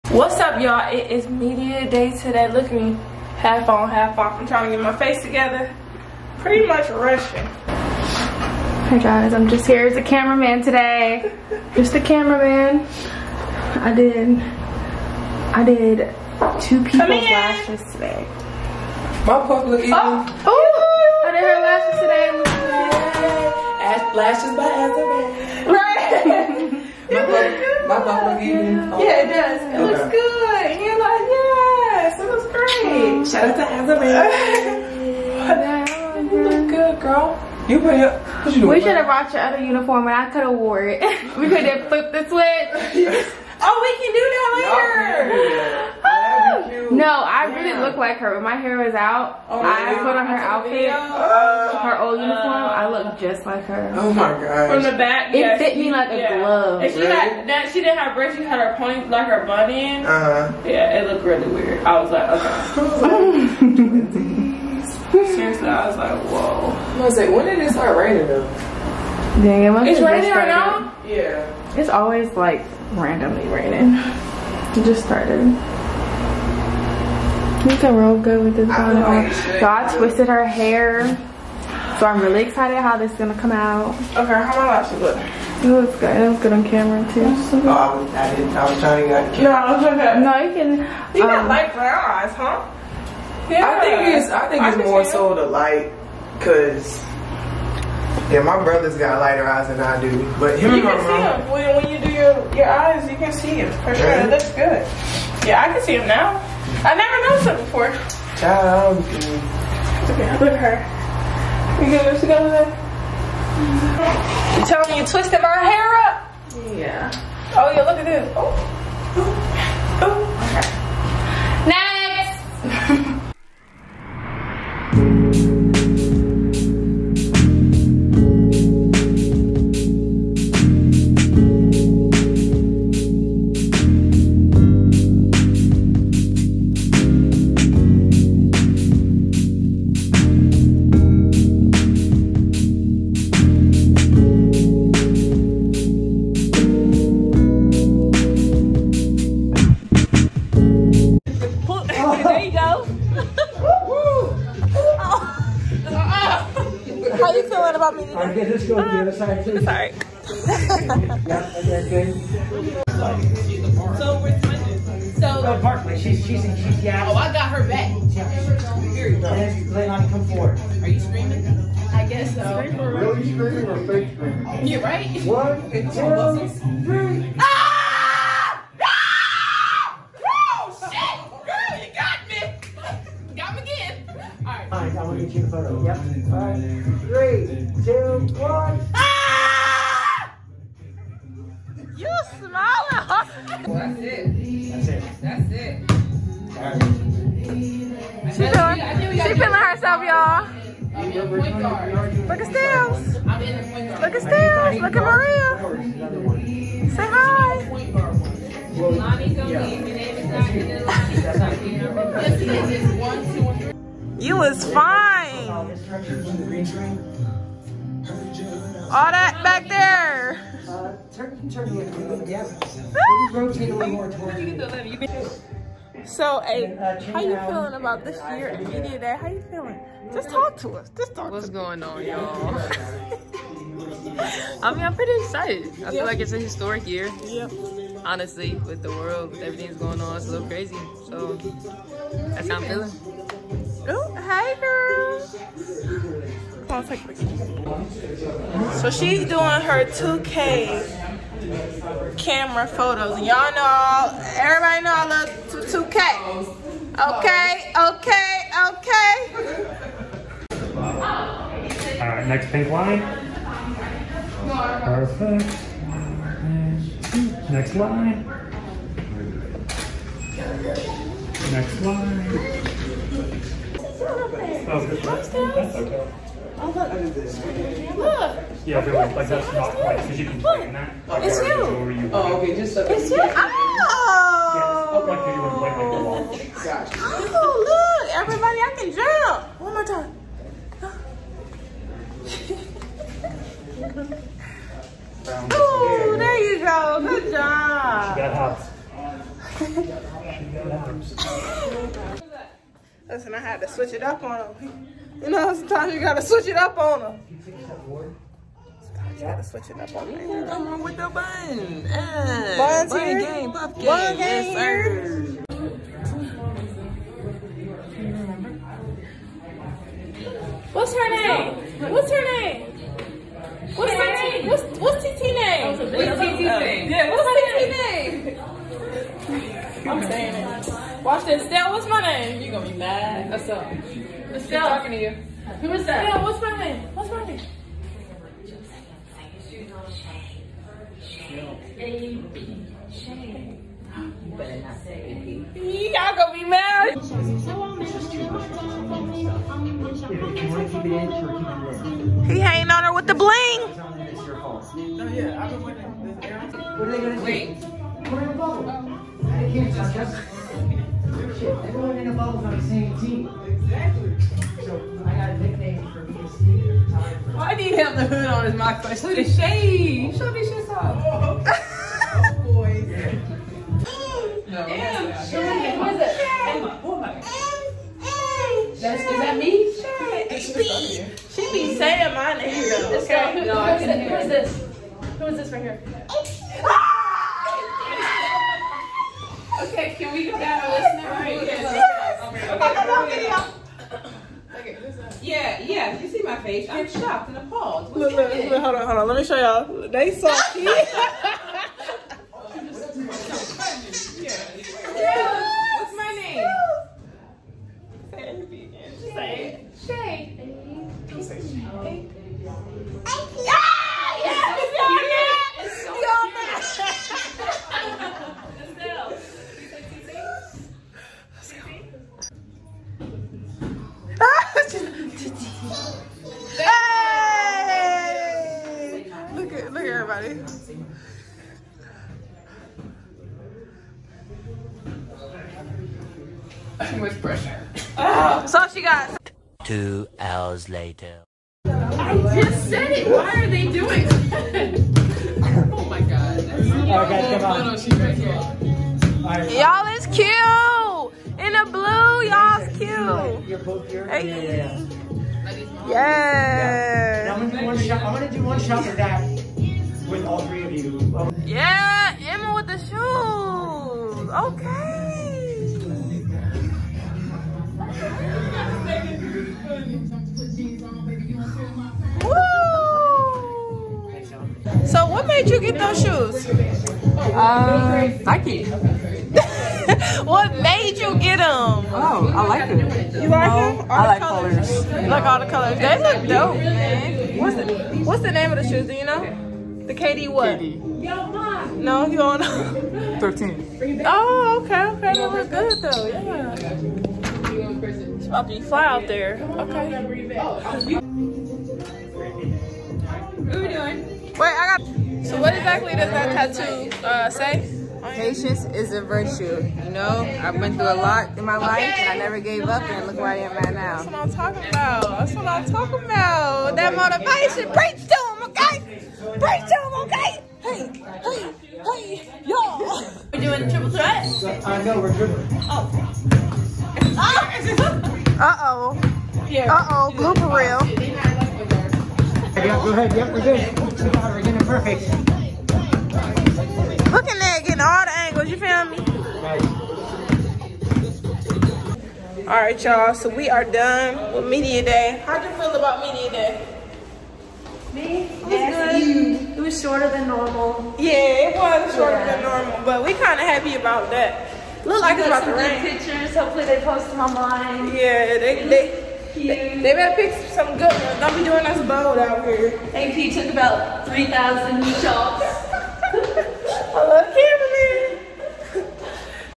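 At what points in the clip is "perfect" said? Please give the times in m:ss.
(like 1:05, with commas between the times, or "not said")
4:24, 8:54.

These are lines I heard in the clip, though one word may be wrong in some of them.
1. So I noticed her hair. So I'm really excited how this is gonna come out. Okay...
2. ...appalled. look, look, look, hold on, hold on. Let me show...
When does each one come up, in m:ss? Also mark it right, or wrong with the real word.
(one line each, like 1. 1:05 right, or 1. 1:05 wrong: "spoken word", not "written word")
1. 1:19 wrong: "twisted", not "noticed"
2. 6:37 right.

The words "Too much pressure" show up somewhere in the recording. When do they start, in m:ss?
7:16.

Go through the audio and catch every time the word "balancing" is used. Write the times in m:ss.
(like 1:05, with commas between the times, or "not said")
not said.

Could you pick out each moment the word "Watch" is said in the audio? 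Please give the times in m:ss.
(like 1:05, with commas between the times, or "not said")
5:31.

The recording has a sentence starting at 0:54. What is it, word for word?
From the back, it yeah, fit she, me like yeah.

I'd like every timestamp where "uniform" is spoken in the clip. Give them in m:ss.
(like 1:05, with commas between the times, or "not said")
0:39, 0:52.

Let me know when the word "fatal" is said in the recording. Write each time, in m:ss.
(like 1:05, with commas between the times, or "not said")
not said.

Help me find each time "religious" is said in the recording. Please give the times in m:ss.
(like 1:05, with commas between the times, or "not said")
not said.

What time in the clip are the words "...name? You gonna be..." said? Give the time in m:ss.
5:31.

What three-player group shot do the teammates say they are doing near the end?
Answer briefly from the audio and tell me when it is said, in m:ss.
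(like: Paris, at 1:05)
Triple threat, at 8:43.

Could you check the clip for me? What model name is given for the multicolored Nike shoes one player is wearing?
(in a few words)
KD 13.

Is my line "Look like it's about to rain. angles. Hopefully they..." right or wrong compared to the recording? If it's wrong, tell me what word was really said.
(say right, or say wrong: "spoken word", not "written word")
wrong: "pictures", not "angles".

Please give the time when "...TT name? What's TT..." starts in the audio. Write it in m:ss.
5:25.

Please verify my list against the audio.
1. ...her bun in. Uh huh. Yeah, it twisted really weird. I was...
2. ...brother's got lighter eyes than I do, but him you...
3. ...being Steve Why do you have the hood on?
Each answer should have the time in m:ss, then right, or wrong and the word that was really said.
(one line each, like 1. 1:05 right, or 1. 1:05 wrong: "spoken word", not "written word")
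1. 0:59 wrong: "looked", not "twisted"
2. 1:38 right
3. 6:06 right.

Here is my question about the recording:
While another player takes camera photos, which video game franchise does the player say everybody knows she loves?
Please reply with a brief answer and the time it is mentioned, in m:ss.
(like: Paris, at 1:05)
2K, at 4:13.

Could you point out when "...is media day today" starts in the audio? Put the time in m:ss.
0:01.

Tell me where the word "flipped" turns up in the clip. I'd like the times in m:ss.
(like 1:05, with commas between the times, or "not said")
0:41.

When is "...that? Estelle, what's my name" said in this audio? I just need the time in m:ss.
5:35.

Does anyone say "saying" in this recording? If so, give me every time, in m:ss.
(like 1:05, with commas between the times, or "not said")
5:30, 6:21.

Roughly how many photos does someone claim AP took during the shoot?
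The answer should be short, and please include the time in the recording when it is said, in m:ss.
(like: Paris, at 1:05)
3,000, at 9:24.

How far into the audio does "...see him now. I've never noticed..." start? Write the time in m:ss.
1:45.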